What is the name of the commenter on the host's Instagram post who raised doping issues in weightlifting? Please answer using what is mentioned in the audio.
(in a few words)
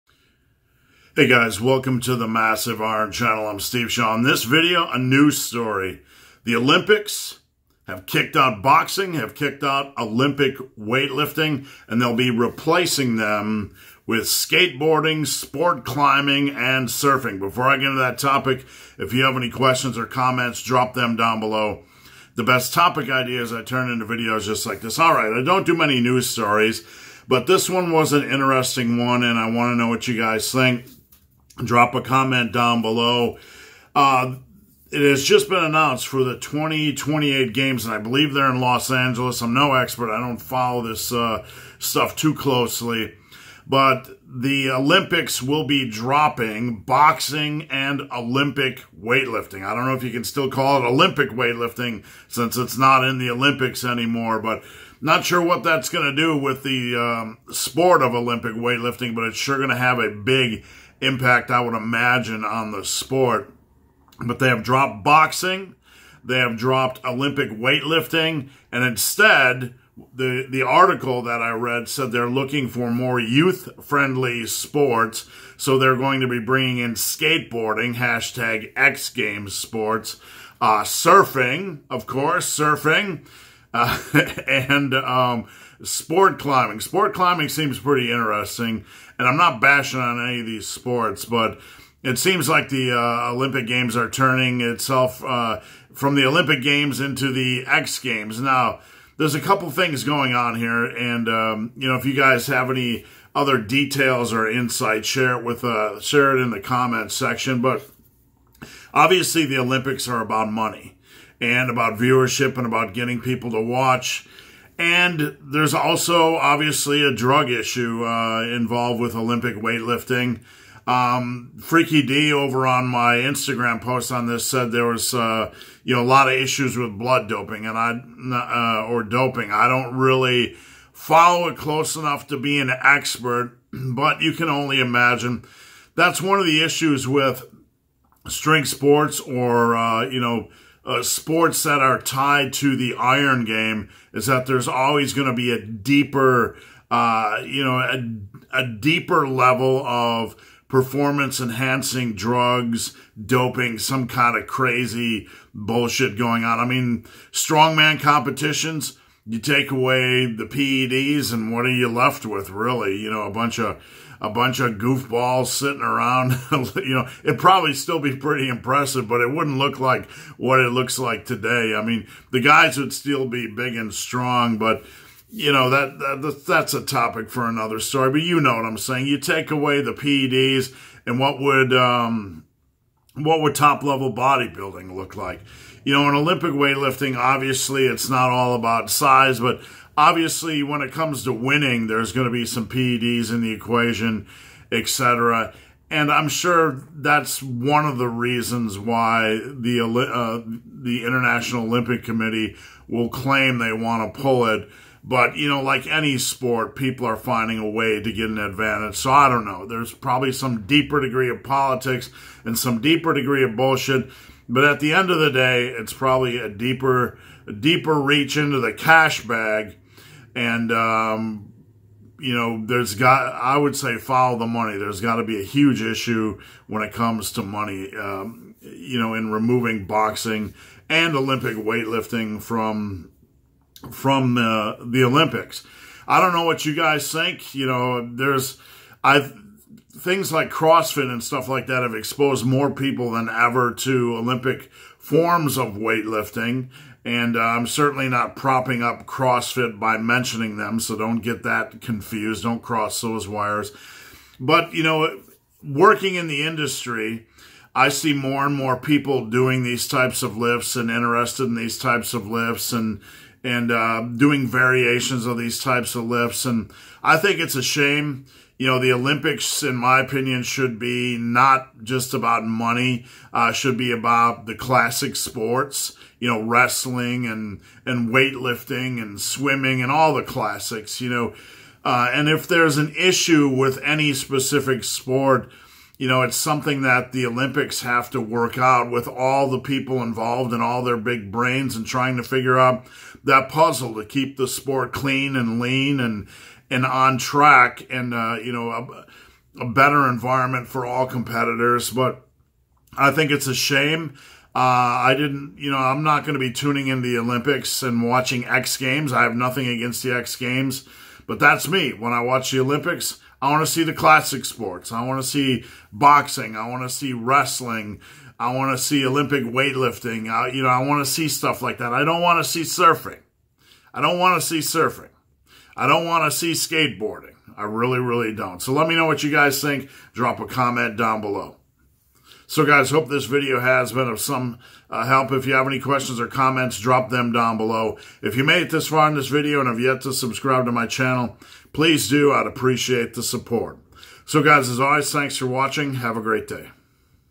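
Freaky D.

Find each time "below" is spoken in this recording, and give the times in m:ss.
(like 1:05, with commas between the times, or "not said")
0:21, 0:32, 5:31, 5:37.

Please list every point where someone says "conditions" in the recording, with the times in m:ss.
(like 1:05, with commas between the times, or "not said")
not said.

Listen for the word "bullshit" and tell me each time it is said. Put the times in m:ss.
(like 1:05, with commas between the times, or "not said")
2:35, 3:33.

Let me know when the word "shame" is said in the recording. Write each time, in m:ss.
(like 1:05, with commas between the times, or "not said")
4:27, 5:03.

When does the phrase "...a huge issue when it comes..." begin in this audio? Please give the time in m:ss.
3:45.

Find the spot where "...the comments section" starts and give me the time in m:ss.
1:46.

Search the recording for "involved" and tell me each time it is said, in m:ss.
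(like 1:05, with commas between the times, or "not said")
1:58, 4:50.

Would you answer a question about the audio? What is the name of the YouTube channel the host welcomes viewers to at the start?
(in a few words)
Massive Iron Channel.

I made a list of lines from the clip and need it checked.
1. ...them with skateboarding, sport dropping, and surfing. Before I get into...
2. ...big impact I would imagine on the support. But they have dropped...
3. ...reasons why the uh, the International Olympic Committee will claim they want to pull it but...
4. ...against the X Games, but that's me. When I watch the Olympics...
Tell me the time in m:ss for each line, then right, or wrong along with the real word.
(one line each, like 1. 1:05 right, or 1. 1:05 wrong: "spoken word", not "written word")
1. 0:13 wrong: "climbing", not "dropping"
2. 1:00 wrong: "sport", not "support"
3. 3:18 right
4. 5:09 right.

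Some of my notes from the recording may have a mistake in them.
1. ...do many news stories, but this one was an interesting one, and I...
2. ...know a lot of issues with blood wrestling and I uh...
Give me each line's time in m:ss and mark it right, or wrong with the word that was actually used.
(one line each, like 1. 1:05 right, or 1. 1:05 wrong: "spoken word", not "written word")
1. 0:25 right
2. 2:05 wrong: "doping", not "wrestling".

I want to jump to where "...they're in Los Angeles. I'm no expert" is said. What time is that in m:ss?
0:38.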